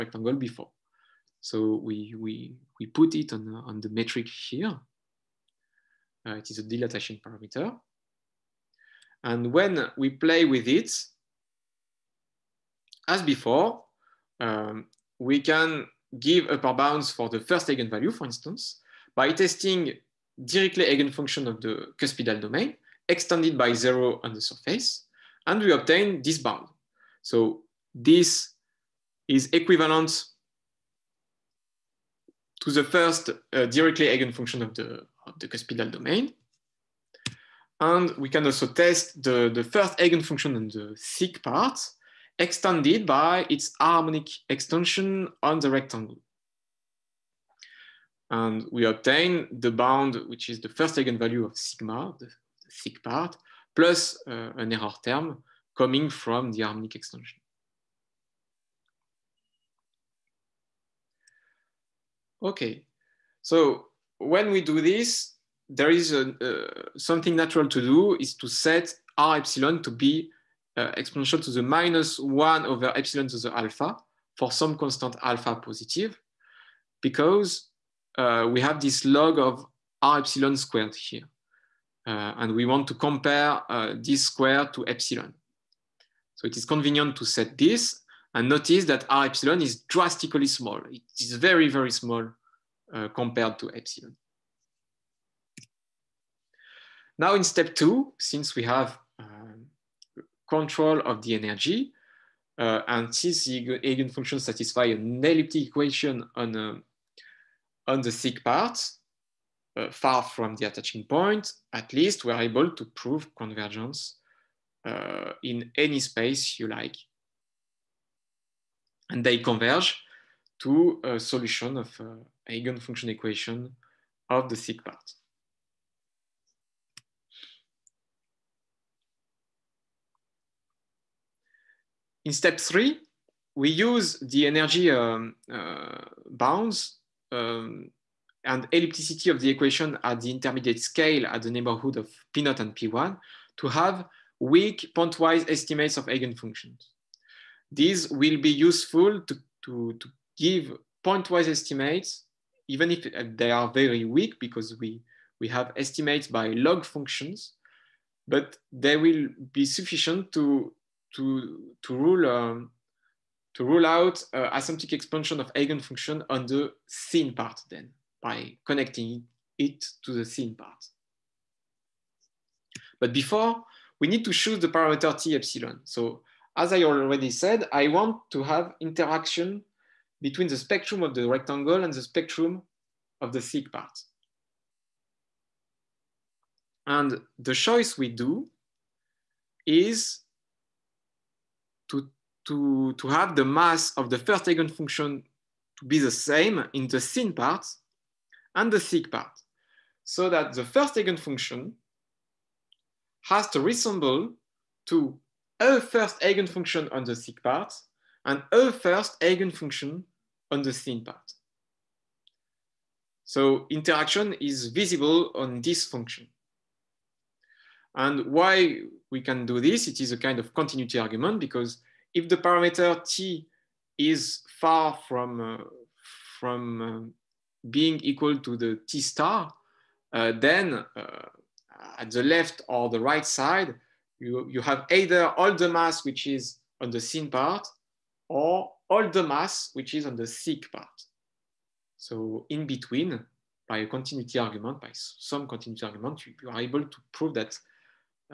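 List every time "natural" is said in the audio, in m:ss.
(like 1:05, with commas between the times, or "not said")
1:07.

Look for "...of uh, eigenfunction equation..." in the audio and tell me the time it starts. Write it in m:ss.
2:01.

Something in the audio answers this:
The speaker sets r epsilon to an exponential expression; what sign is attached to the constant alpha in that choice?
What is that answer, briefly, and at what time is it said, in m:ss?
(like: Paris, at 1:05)
Positive, at 1:15.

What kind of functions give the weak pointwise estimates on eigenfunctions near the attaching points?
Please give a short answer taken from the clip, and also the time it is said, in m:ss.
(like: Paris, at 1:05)
Log functions, at 2:36.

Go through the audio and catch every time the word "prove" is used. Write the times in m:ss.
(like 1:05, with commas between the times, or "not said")
1:52, 4:07.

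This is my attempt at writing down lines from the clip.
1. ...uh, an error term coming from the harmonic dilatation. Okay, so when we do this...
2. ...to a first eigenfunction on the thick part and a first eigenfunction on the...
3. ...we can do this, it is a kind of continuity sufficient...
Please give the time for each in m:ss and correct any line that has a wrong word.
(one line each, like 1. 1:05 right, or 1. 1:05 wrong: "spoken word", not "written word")
1. 0:54 wrong: "extension", not "dilatation"
2. 3:24 right
3. 3:39 wrong: "argument", not "sufficient".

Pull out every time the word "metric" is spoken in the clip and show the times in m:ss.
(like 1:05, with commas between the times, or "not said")
0:03.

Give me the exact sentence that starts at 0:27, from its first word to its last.
So this is equivalent to the first uh, Dirichlet eigenfunction of the, of the cuspidal domain.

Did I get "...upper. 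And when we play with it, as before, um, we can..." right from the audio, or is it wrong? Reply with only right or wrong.
wrong.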